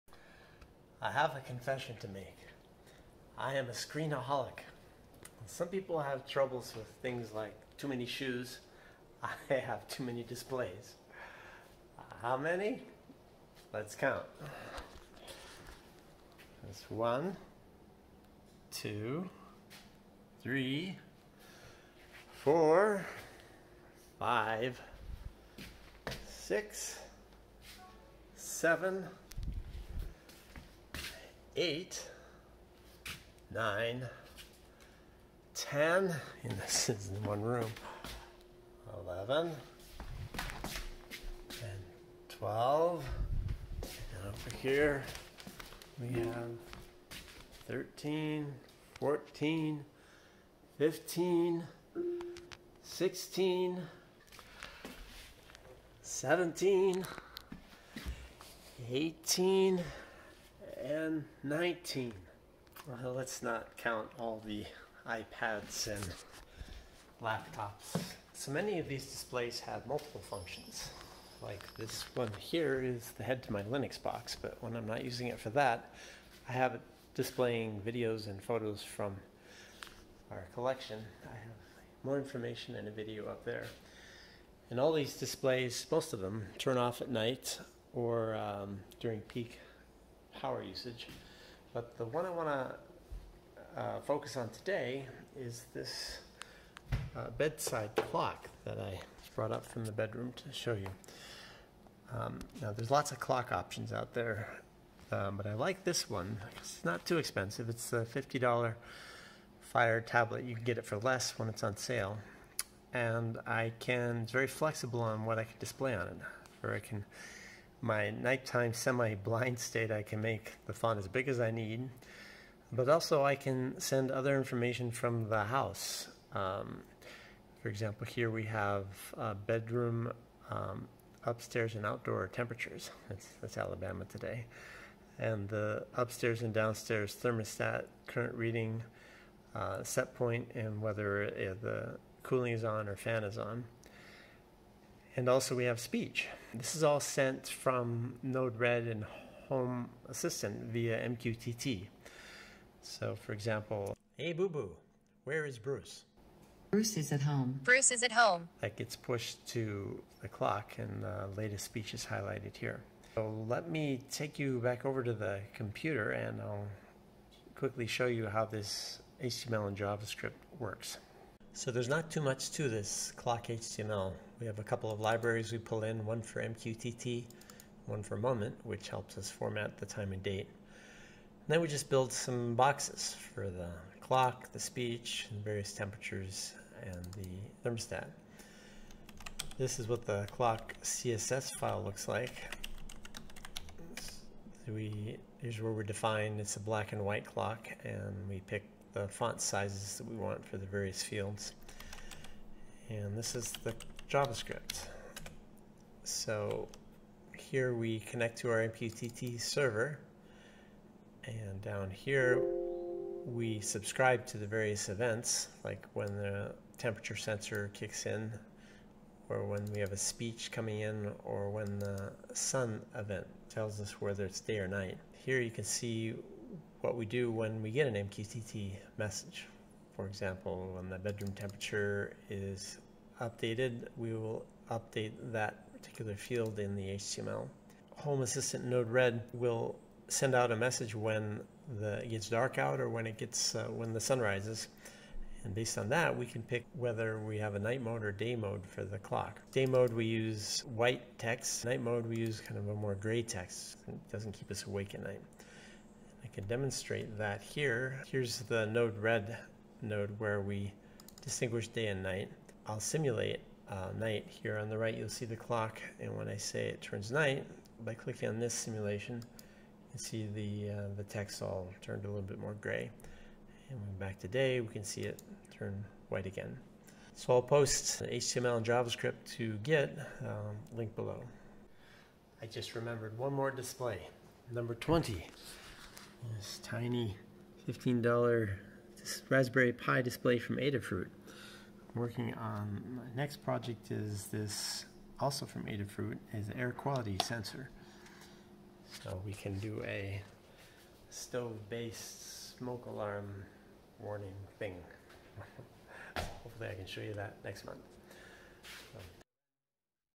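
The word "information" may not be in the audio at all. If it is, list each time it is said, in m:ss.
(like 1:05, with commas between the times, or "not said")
1:22, 2:04.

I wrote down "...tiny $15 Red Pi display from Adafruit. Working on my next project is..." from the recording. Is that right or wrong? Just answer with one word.
wrong.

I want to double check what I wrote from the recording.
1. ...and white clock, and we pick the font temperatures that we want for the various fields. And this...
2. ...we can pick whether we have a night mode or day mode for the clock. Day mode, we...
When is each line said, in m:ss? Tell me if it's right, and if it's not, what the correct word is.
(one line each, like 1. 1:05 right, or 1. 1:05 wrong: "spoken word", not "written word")
1. 3:16 wrong: "sizes", not "temperatures"
2. 4:06 right.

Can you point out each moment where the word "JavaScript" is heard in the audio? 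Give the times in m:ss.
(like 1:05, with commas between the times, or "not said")
2:49, 3:24, 4:38.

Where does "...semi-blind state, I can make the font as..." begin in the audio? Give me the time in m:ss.
1:58.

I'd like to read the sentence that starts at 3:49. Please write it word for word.
For example, when the bedroom temperature is updated, we will update that particular field in the HTML.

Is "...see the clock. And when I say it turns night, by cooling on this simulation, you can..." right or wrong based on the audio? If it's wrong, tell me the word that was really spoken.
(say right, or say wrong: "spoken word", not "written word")
wrong: "clicking", not "cooling".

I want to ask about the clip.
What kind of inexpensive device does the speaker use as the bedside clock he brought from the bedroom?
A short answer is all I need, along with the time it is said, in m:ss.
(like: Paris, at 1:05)
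Fire tablet, at 1:49.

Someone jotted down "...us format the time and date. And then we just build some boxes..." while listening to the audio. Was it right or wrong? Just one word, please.
right.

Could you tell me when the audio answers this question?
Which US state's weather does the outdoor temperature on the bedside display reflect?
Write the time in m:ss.
2:13.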